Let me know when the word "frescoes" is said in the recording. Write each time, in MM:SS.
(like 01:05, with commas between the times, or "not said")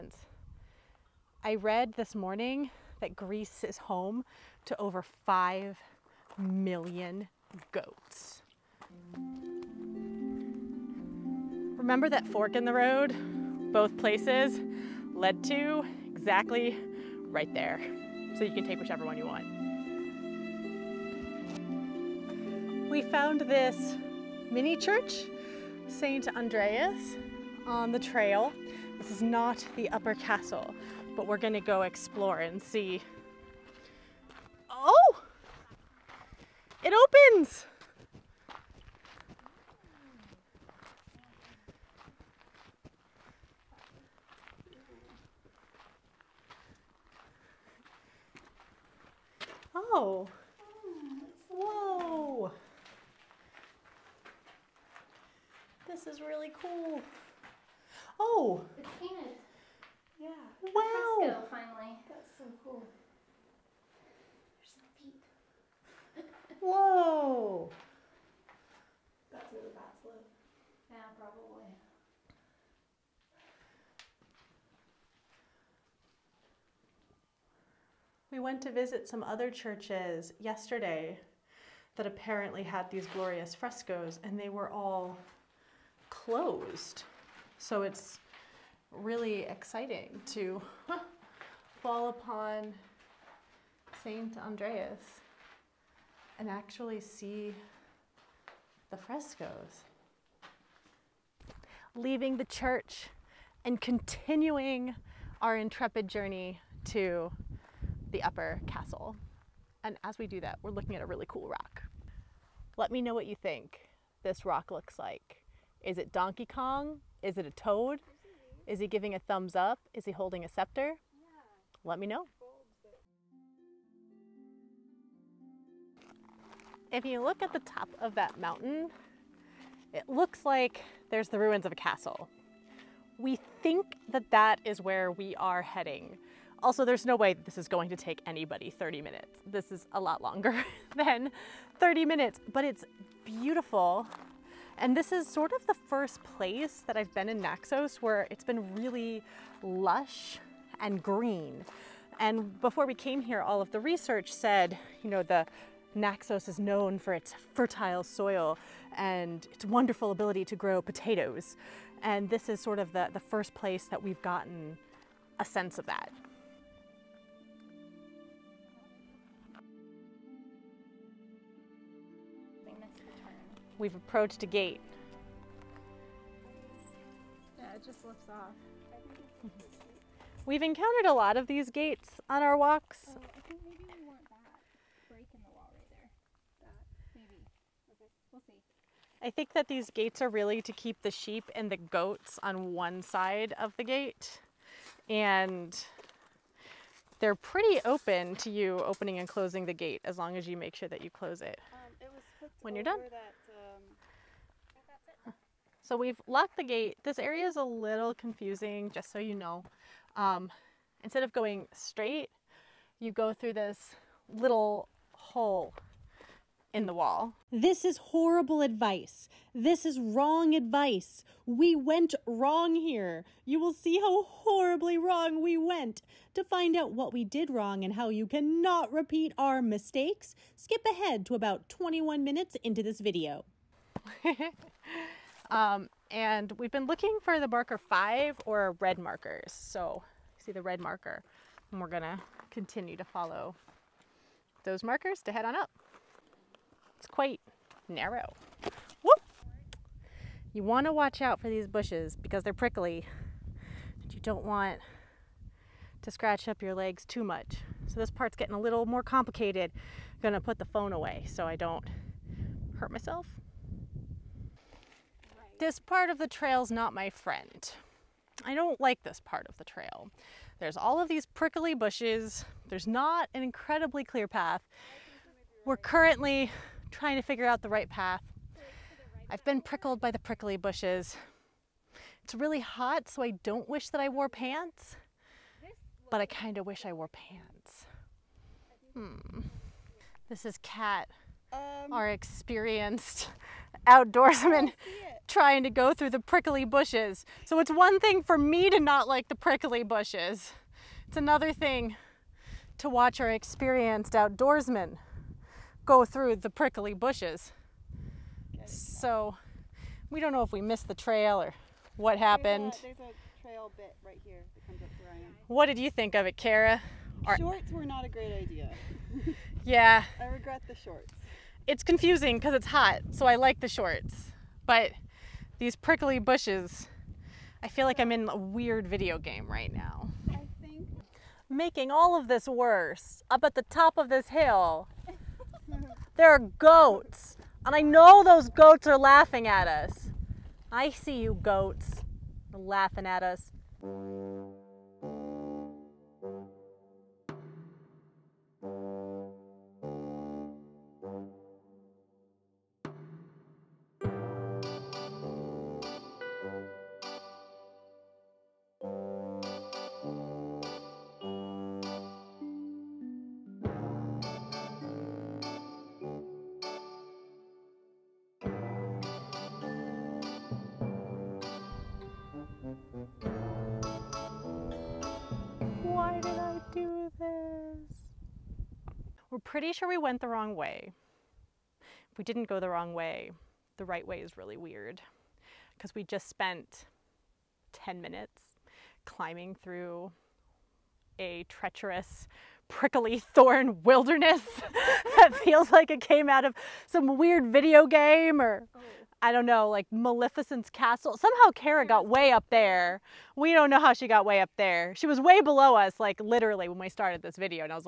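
01:23, 01:38.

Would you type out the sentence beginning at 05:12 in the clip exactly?
There's a, there's a trail bit right here that comes up where I am.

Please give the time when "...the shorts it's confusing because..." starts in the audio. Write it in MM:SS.
05:20.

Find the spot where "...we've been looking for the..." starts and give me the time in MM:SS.
03:56.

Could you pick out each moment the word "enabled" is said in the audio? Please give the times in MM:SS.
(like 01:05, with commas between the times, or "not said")
not said.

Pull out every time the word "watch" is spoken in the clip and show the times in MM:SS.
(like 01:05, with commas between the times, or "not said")
04:10, 05:02.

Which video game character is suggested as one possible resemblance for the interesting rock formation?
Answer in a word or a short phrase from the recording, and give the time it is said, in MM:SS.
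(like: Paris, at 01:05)
Donkey Kong, at 01:56.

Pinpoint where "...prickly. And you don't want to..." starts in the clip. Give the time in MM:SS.
04:12.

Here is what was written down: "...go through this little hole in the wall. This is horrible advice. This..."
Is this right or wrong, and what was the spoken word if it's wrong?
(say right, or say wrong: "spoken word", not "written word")
right.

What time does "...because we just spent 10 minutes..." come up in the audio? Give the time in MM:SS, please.
06:25.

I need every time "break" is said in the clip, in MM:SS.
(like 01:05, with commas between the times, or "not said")
03:05.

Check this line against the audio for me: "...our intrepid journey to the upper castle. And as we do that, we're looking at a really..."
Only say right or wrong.
right.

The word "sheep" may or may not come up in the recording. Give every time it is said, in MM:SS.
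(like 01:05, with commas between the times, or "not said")
03:11.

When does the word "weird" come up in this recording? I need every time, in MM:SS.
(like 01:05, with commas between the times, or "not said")
05:28, 06:24, 06:37.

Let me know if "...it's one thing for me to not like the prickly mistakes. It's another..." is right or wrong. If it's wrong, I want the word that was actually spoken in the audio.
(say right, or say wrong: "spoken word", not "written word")
wrong: "bushes", not "mistakes".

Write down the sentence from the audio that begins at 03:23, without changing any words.
That, so we've locked the gate.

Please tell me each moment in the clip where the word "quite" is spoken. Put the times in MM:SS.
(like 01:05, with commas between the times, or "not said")
04:07.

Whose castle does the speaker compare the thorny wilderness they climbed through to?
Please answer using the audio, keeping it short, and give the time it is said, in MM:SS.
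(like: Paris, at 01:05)
Maleficent's, at 06:39.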